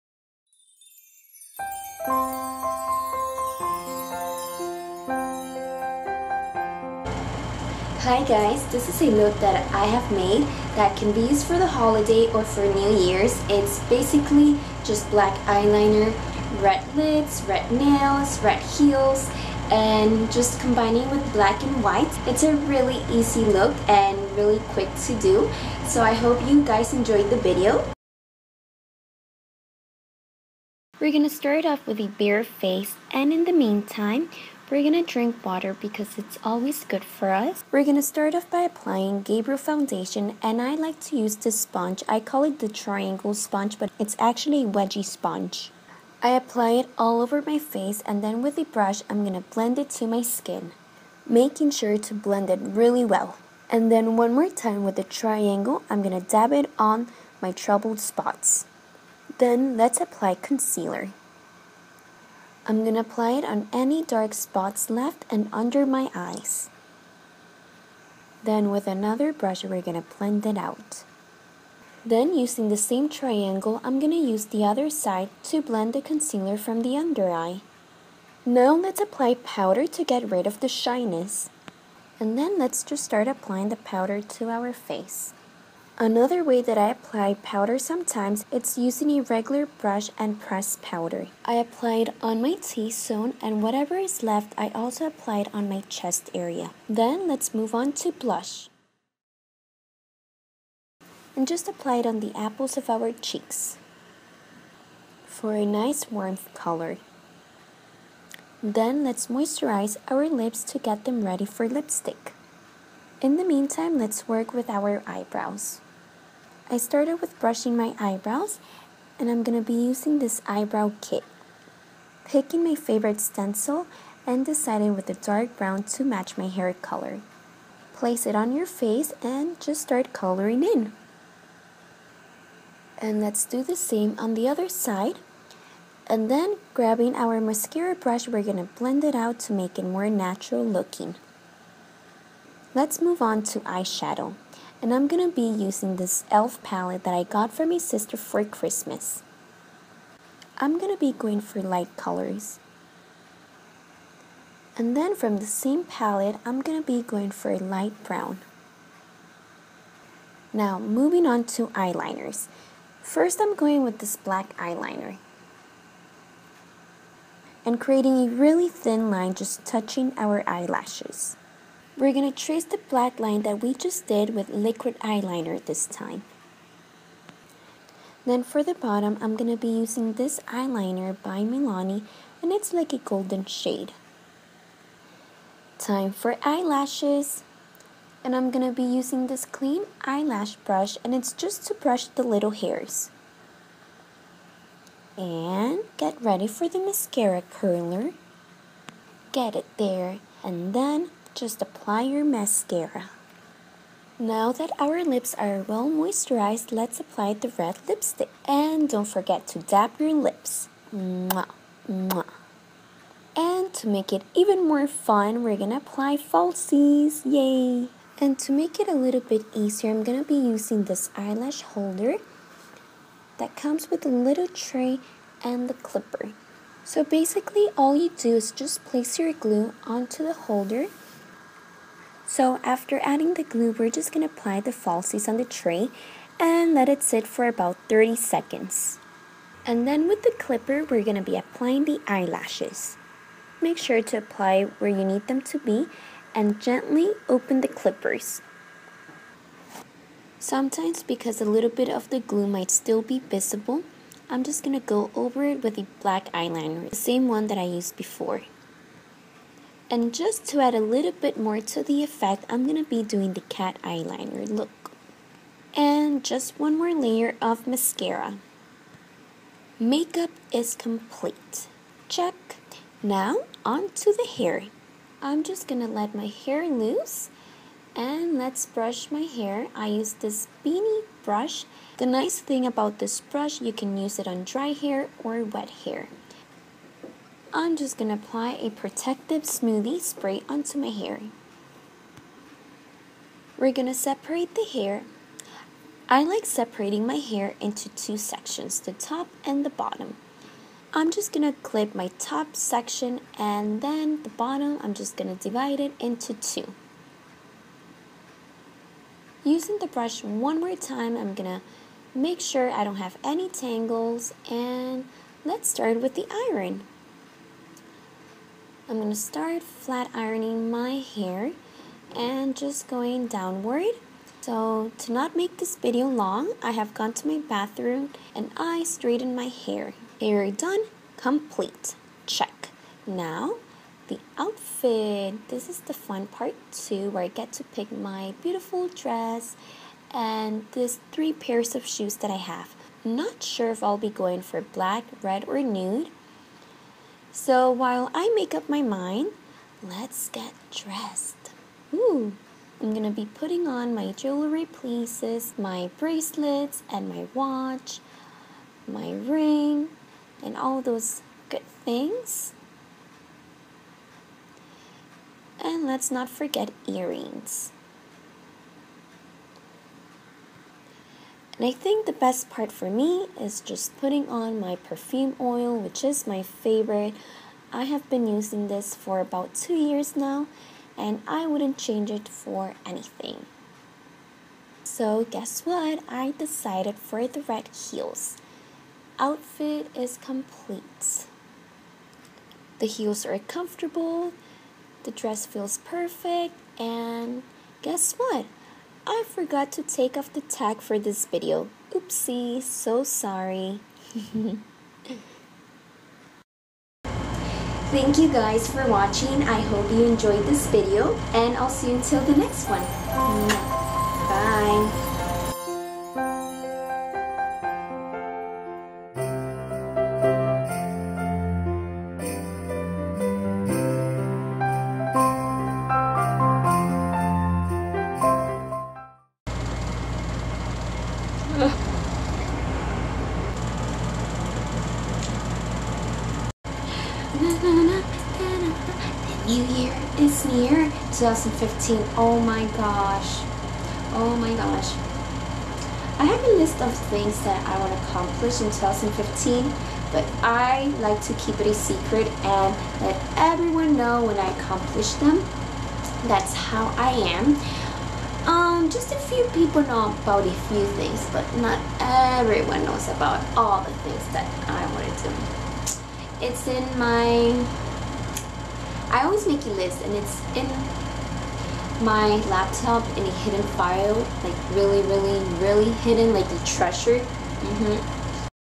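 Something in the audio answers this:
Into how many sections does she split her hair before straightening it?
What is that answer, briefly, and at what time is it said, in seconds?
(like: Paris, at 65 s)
2, at 297 s.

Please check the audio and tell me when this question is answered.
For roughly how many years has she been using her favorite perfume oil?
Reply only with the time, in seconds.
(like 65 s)
379 s.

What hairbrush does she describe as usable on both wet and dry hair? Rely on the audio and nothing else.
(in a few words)
beanie brush.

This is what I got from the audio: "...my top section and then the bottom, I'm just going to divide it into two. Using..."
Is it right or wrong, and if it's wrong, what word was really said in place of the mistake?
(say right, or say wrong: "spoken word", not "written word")
right.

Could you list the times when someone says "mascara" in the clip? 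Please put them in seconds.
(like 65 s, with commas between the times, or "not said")
137 s, 196 s, 202 s, 267 s.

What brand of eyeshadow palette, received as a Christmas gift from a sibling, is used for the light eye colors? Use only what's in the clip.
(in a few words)
e.l.f.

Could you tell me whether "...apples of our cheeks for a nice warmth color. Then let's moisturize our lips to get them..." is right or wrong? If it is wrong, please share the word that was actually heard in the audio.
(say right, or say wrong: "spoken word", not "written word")
right.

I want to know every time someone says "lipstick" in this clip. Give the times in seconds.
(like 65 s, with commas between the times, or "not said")
111 s, 207 s.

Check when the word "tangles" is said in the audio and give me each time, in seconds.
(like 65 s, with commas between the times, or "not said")
313 s.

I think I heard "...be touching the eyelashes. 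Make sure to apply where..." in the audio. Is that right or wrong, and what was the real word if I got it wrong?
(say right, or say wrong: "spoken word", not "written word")
wrong: "applying", not "touching".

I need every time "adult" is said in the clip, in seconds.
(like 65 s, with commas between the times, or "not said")
not said.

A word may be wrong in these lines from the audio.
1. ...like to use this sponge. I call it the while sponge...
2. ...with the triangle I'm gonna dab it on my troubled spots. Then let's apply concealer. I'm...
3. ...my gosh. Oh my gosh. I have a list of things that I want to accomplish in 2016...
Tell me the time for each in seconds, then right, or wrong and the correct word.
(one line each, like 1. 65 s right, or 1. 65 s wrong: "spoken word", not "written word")
1. 40 s wrong: "triangle", not "while"
2. 54 s right
3. 442 s wrong: "2015", not "2016".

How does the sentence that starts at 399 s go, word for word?
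I forgot to take off the tag for this video.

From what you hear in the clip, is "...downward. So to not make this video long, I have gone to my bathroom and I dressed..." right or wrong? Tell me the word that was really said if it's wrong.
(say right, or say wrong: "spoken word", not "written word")
wrong: "straightened", not "dressed".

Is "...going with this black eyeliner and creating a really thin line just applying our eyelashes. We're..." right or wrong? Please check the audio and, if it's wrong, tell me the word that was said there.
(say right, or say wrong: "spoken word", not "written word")
wrong: "touching", not "applying".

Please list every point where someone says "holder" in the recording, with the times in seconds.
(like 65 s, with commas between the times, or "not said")
221 s, 230 s.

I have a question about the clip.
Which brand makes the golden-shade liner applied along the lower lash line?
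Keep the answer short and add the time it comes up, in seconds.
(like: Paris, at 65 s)
Milani, at 181 s.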